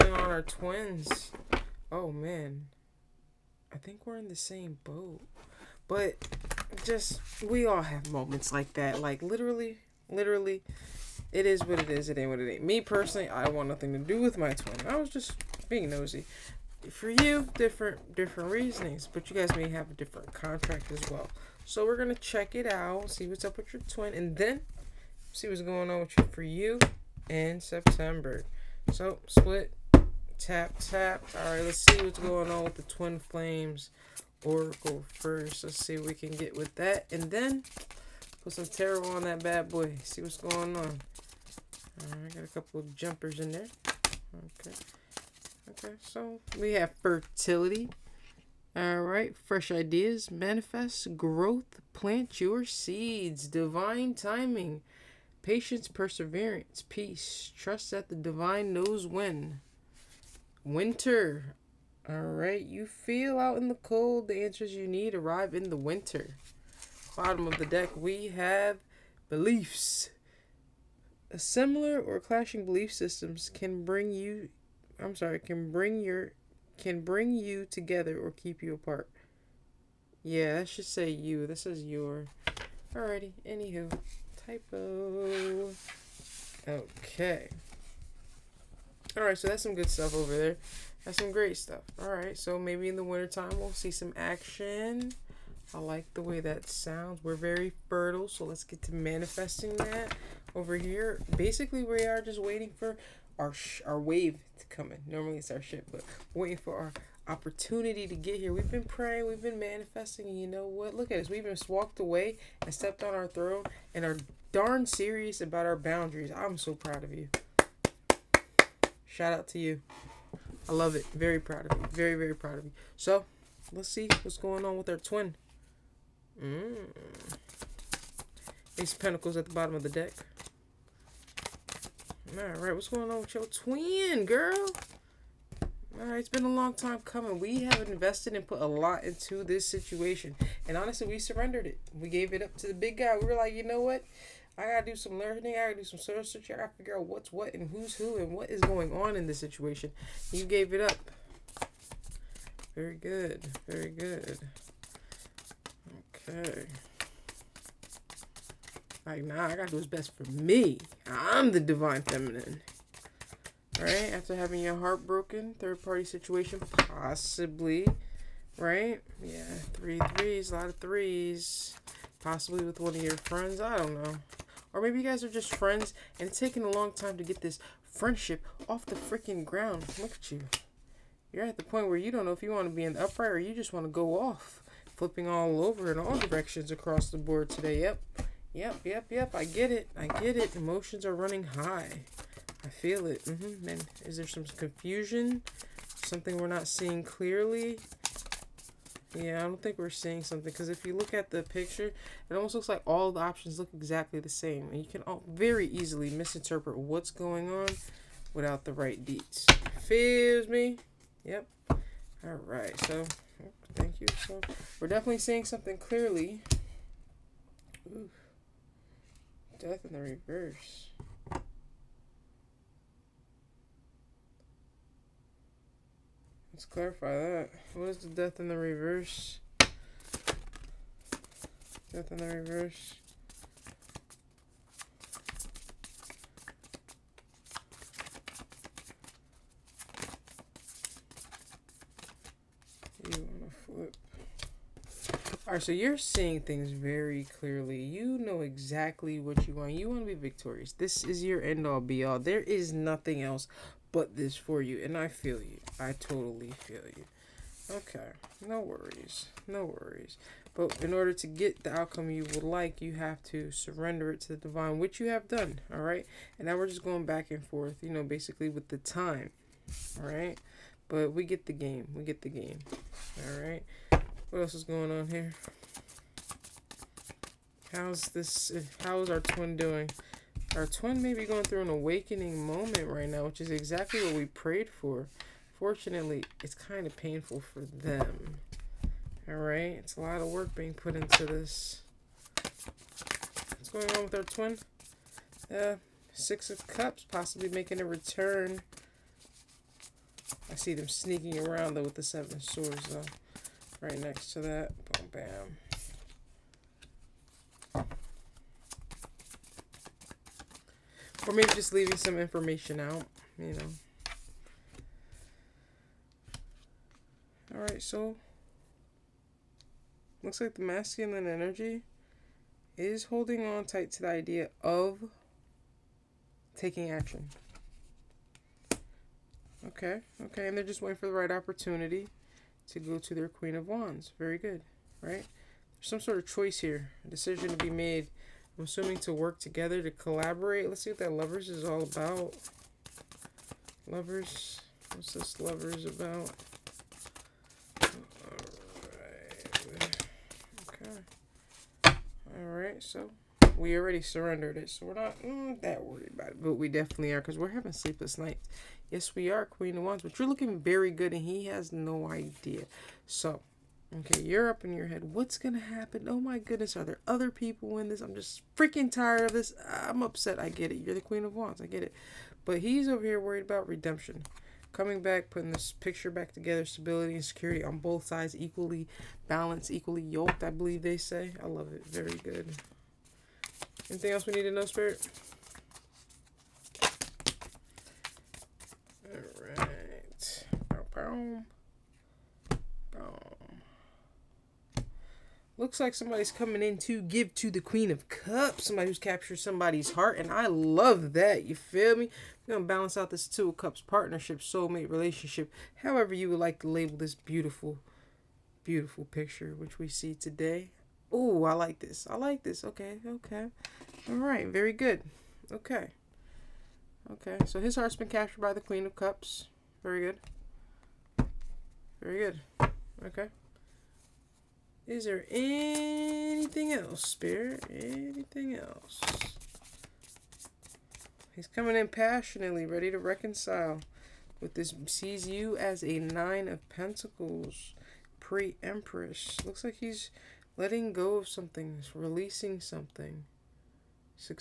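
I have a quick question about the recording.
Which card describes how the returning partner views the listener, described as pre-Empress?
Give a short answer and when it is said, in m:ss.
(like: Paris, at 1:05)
Nine of Pentacles, at 7:15.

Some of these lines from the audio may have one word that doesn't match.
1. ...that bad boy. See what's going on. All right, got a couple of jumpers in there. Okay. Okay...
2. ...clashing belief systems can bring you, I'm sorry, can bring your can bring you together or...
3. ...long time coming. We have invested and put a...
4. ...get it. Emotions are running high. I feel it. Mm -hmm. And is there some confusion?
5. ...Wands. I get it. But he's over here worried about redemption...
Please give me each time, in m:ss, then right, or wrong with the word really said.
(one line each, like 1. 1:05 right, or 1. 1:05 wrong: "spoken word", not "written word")
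1. 0:39 right
2. 1:12 right
3. 2:16 right
4. 3:10 right
5. 6:11 right.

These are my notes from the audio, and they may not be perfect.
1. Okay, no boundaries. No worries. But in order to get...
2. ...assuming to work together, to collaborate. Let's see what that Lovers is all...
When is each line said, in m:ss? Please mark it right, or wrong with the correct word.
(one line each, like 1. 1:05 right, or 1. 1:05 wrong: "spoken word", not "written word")
1. 4:17 wrong: "worries", not "boundaries"
2. 5:38 right.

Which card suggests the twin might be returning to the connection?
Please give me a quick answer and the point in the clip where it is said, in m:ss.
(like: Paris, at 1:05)
Six of Cups, at 4:56.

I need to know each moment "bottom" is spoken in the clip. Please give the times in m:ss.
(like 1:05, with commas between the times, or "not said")
1:07, 2:09.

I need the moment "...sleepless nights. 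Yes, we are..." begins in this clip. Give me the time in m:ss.
5:57.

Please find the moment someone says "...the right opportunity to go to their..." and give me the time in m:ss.
5:31.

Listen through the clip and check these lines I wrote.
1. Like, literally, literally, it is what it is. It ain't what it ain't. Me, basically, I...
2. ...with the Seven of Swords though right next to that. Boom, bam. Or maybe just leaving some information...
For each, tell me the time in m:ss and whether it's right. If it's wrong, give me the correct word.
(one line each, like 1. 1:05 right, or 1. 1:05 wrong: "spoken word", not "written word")
1. 0:09 wrong: "personally", not "basically"
2. 5:01 right.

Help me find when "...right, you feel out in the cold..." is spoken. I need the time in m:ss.
1:02.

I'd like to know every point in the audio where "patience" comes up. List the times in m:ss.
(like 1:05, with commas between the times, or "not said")
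0:55.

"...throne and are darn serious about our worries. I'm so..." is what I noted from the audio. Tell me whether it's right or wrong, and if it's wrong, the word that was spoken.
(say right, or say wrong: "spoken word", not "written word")
wrong: "boundaries", not "worries".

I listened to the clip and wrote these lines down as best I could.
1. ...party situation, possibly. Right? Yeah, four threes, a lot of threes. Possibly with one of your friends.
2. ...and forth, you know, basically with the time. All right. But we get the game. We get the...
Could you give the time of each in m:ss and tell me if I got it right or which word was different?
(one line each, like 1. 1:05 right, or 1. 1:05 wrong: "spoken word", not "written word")
1. 2:45 wrong: "three", not "four"
2. 4:27 right.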